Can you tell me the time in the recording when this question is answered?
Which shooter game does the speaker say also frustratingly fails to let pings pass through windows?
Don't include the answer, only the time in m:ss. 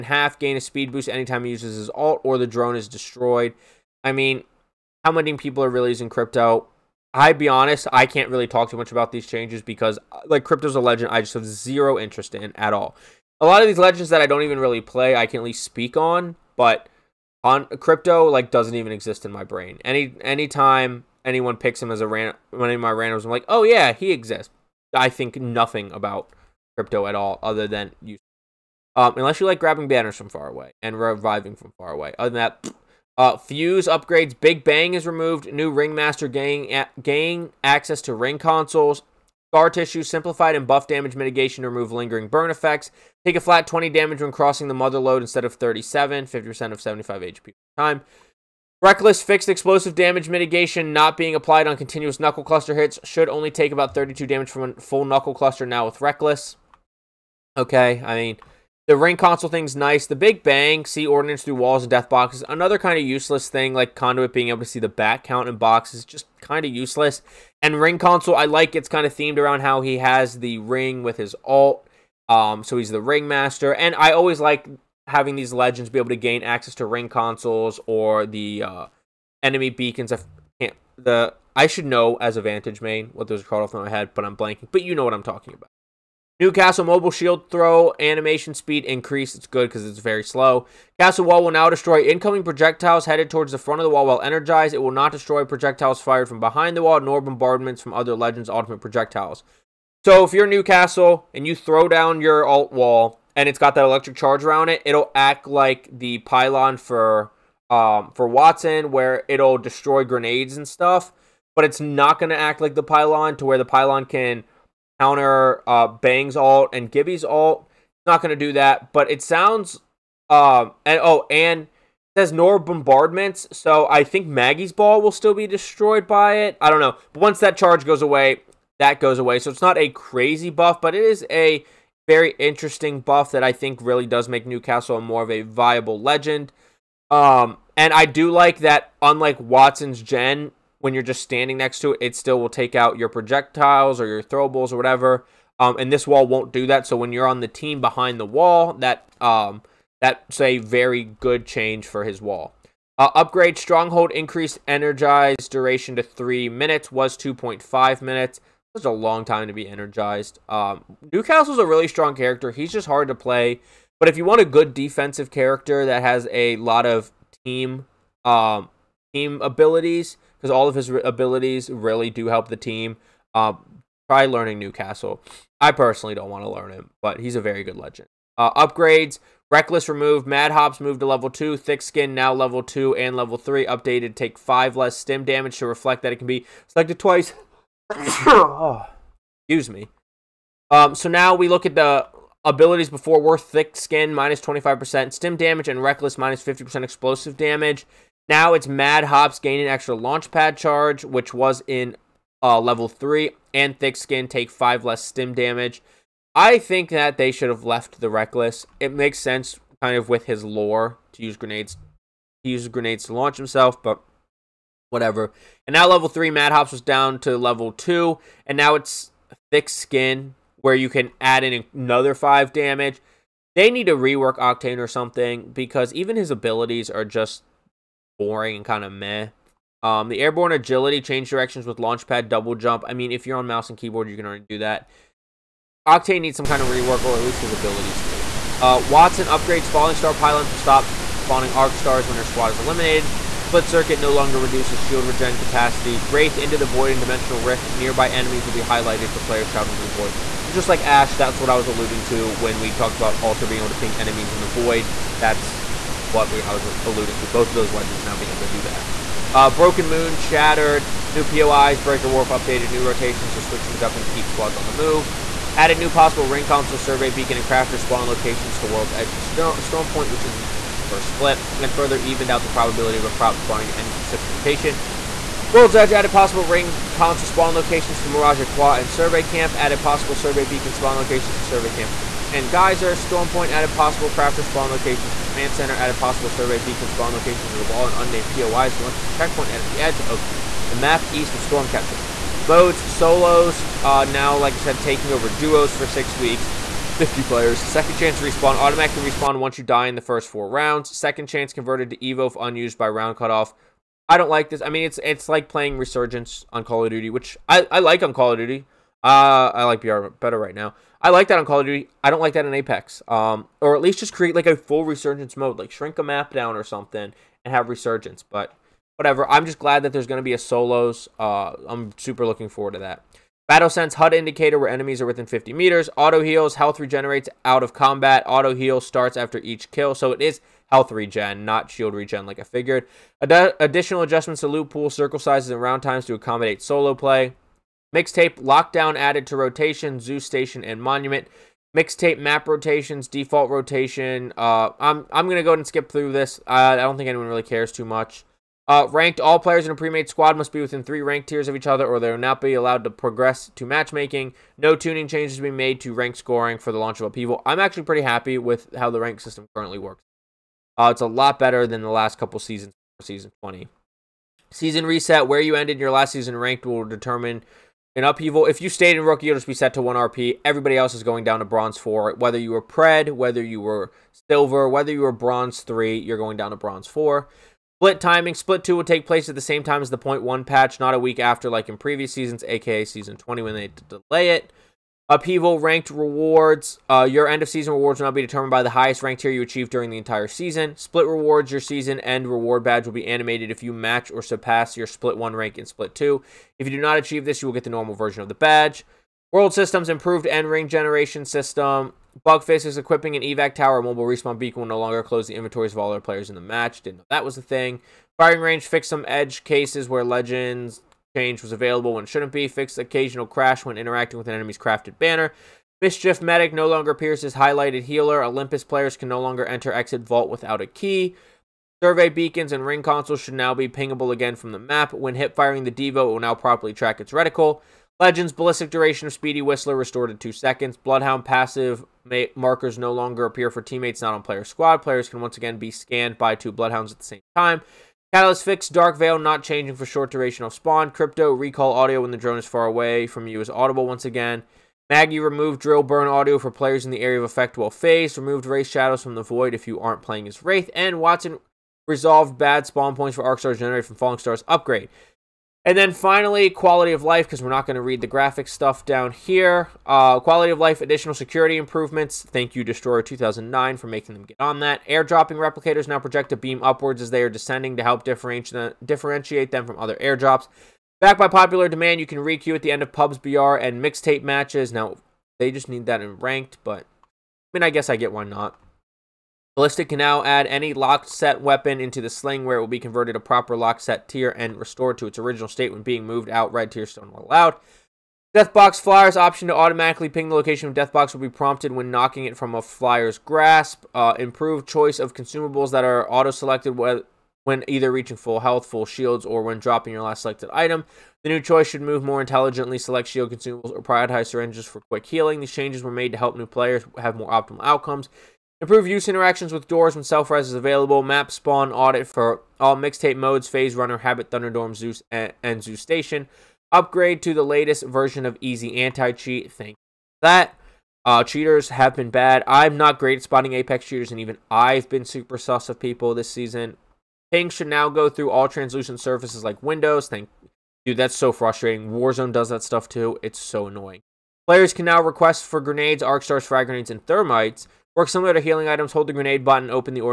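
8:51.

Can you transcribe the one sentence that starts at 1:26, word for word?
Newcastle Mobile Shield throw animation speed increase.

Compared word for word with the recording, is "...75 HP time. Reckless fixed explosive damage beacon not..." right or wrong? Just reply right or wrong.
wrong.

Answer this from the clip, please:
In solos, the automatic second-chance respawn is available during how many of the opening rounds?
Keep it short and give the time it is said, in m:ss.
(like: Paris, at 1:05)
4, at 5:00.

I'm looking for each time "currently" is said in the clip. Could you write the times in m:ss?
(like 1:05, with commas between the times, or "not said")
5:59.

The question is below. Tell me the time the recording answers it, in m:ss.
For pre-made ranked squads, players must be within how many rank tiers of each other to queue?
5:50.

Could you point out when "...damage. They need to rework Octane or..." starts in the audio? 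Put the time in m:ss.
3:42.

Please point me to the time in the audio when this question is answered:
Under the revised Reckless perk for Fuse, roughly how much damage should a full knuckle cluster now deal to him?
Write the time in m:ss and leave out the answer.
0:53.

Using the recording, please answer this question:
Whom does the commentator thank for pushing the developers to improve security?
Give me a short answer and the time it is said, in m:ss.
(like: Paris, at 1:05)
Destroyer 2009, at 7:42.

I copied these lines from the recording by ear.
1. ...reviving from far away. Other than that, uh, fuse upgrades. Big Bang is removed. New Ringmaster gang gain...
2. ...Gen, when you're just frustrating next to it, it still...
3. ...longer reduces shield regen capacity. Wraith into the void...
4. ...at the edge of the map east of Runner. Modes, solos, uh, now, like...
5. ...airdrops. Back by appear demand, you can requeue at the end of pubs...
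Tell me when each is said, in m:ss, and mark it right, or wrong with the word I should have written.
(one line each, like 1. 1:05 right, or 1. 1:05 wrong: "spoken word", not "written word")
1. 0:30 right
2. 2:20 wrong: "standing", not "frustrating"
3. 4:04 right
4. 4:49 wrong: "Stormcatcher", not "Runner"
5. 7:49 wrong: "popular", not "appear".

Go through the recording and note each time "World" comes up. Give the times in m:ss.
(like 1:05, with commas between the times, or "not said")
4:28, 4:35, 6:39.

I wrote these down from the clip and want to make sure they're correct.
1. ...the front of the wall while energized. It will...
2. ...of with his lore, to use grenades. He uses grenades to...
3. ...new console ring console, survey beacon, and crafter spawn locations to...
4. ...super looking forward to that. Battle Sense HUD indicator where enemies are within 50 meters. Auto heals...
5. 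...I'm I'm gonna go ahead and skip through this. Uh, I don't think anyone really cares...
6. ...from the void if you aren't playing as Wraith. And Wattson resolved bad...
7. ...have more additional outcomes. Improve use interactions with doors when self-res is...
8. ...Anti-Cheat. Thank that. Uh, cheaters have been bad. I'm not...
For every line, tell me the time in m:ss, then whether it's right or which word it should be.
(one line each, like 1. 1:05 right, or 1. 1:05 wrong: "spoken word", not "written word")
1. 1:33 right
2. 3:29 right
3. 4:25 wrong: "possible", not "console"
4. 5:21 right
5. 5:44 right
6. 7:29 right
7. 8:26 wrong: "optimal", not "additional"
8. 8:38 right.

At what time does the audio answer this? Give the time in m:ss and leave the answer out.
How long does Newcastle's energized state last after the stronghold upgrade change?
2:36.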